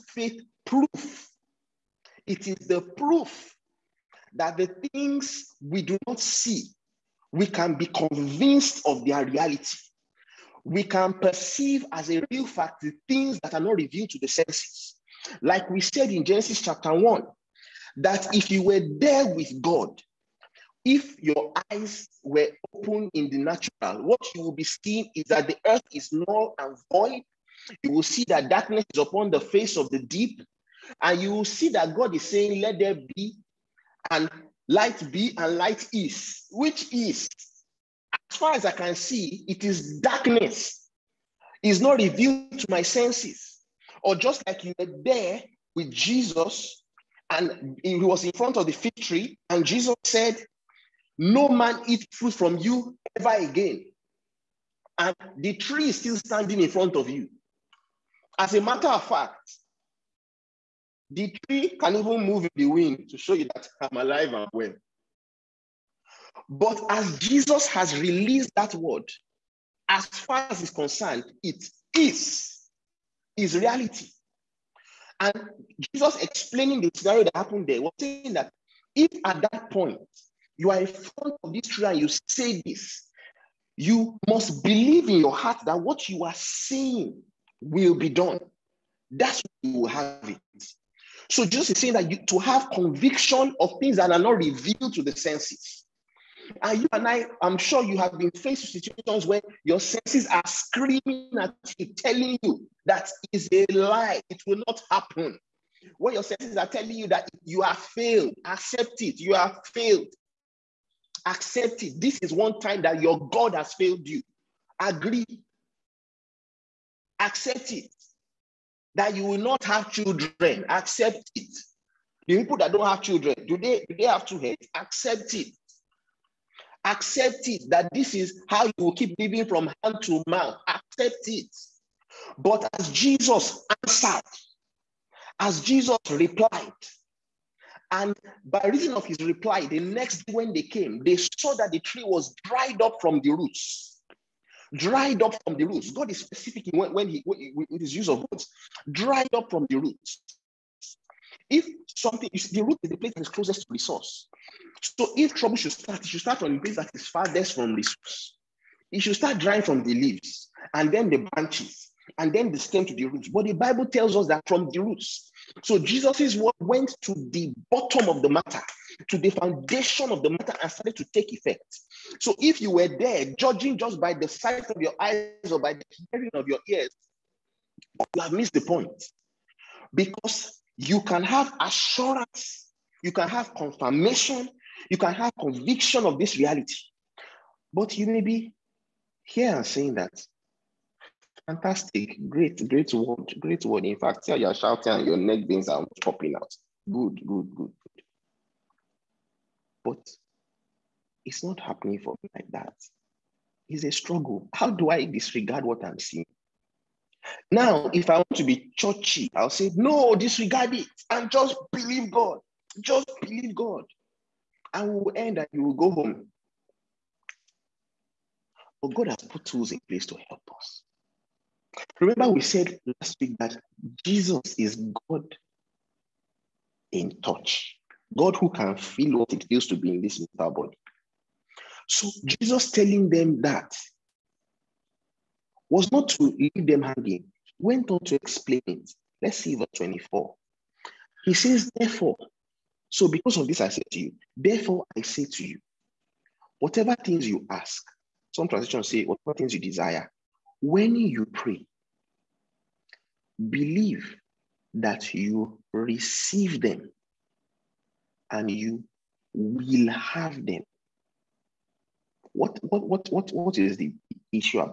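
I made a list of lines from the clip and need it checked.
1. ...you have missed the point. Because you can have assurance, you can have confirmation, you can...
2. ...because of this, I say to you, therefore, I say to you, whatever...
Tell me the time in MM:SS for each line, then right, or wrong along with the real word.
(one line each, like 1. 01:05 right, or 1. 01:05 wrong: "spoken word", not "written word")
1. 02:58 right
2. 04:03 right.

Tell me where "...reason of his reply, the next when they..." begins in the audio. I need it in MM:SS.
02:18.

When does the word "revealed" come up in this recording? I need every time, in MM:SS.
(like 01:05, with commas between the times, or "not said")
00:13, 00:41, 01:34.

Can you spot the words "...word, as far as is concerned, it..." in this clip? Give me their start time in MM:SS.
01:08.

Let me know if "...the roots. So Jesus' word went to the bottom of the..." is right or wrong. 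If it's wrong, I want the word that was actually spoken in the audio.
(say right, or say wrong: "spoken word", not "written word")
right.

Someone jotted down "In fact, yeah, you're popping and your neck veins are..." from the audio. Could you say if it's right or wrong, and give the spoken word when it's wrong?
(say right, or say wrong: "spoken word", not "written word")
wrong: "shouting", not "popping".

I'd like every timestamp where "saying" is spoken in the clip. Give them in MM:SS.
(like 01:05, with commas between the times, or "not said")
00:32, 01:18, 01:26, 01:31, 03:09.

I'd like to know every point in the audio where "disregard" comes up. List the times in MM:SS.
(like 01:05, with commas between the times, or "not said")
03:25, 03:30.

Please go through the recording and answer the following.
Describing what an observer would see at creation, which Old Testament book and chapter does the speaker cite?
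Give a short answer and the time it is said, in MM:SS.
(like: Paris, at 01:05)
Genesis chapter 1, at 00:16.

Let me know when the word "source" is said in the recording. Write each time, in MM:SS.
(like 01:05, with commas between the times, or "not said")
02:33, 02:37.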